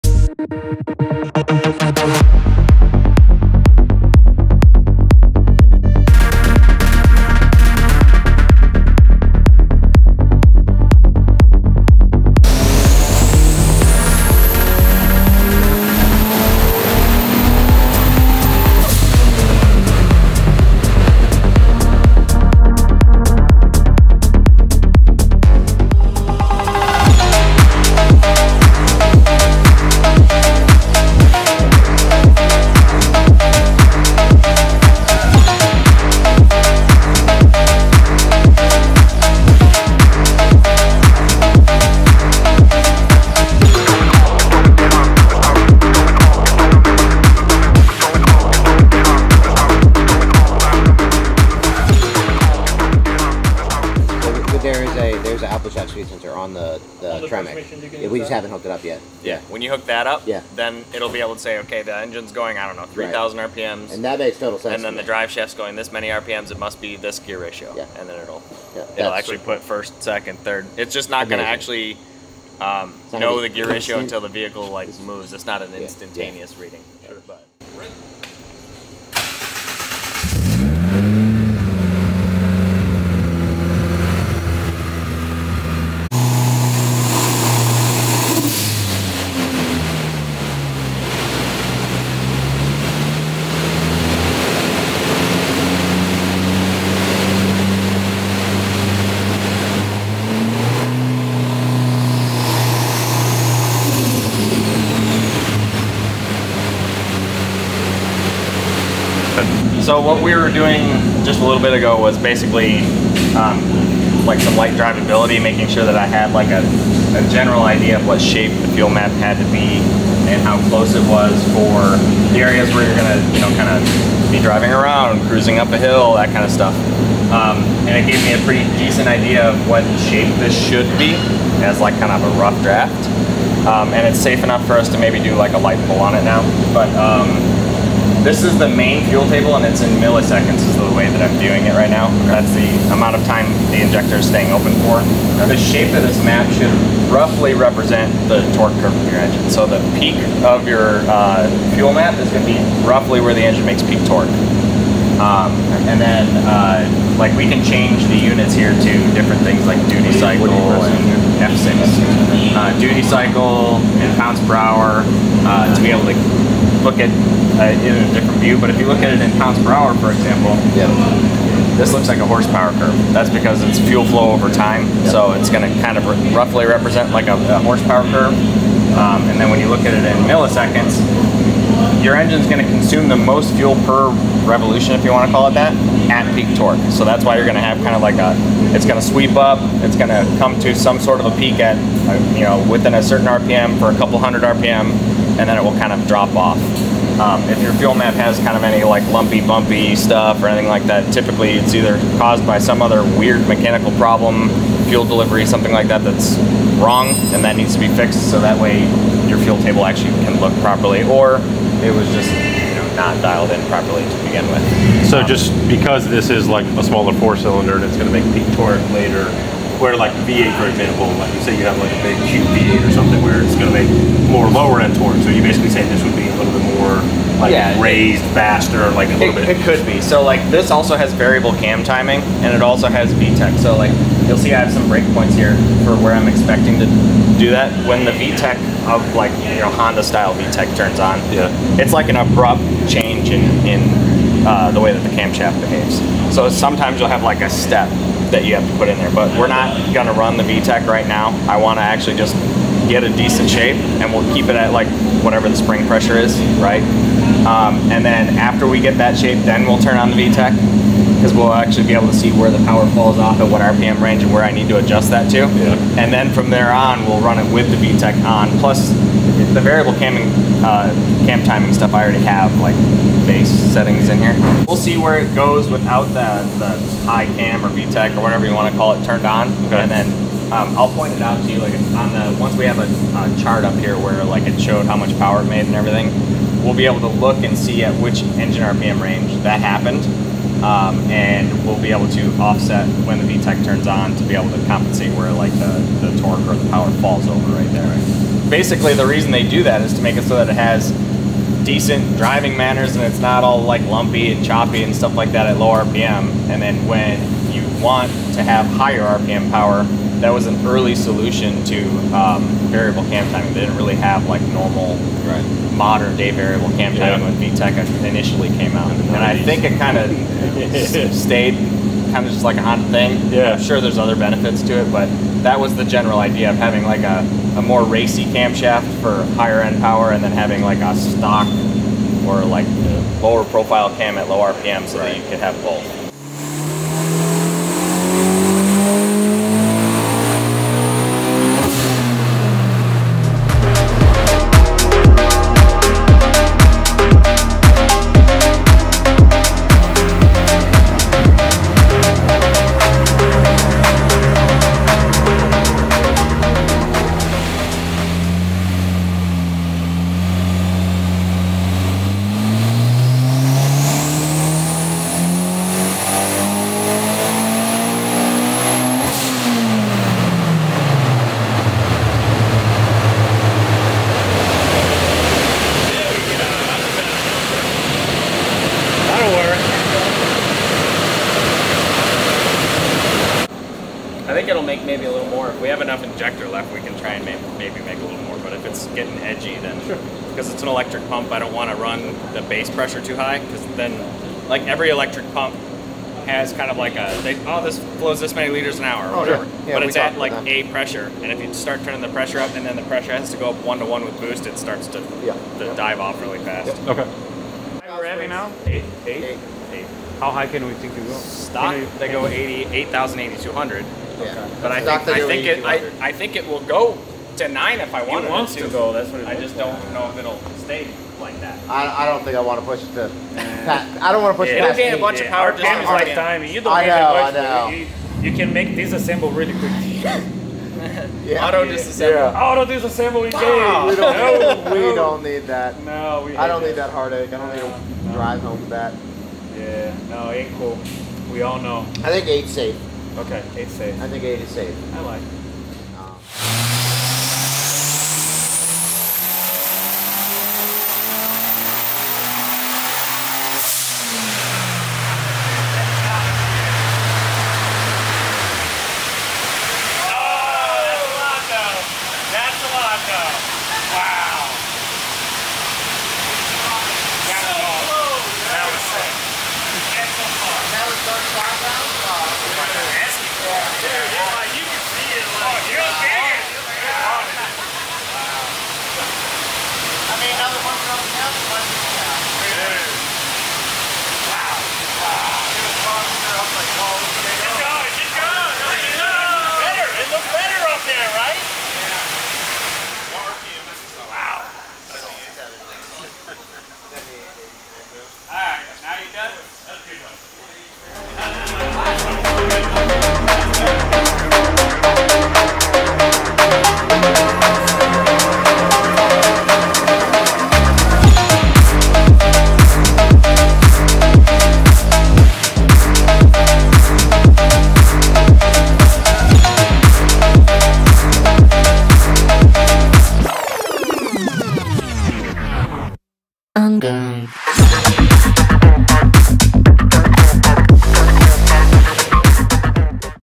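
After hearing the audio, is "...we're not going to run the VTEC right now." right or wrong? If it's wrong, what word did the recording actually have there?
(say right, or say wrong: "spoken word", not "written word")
right.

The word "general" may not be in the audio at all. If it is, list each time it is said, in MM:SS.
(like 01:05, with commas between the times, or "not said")
01:57, 05:25.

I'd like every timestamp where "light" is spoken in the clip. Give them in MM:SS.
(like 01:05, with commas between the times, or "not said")
01:54, 02:15.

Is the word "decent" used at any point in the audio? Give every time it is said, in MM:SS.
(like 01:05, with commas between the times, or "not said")
02:08, 04:13, 05:01.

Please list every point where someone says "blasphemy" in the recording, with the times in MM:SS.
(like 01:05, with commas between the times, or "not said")
not said.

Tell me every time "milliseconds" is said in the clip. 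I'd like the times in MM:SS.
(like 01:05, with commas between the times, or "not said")
02:19, 03:00.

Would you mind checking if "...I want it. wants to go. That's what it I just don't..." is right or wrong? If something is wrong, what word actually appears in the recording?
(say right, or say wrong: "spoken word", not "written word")
right.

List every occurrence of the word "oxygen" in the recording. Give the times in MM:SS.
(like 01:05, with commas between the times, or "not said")
not said.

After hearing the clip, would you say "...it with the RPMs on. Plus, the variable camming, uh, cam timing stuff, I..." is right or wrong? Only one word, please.
wrong.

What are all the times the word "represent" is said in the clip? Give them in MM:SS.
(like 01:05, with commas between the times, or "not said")
02:27, 02:56.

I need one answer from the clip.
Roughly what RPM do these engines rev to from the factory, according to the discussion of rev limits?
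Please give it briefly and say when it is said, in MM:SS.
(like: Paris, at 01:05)
8,200, at 06:53.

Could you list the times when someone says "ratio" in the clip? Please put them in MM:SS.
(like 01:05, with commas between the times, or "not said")
01:07, 01:13.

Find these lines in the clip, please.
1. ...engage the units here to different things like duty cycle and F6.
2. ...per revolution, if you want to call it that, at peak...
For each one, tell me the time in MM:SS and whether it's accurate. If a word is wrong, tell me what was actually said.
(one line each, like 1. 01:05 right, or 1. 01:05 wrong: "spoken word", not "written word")
1. 02:37 wrong: "change", not "engage"
2. 03:03 right.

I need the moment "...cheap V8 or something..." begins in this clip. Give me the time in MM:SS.
03:42.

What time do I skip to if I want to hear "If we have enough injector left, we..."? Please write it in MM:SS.
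06:25.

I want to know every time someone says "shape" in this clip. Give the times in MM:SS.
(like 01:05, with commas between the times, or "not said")
01:58, 02:10, 02:25, 04:13, 04:19.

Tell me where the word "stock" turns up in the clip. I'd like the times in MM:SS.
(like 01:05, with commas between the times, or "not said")
05:30, 06:51.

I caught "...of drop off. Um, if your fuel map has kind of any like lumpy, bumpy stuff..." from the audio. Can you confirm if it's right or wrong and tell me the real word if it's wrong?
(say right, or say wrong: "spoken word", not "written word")
right.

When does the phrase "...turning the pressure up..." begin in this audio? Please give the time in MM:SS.
06:41.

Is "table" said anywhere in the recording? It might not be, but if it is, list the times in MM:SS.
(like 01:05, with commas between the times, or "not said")
02:19, 03:29.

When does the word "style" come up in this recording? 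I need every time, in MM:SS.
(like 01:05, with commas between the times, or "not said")
04:00.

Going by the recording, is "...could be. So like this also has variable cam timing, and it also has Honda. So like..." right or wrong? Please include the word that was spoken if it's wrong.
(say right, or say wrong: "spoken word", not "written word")
wrong: "VTEC", not "Honda".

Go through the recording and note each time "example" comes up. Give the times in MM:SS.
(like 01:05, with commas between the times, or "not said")
02:50, 03:40.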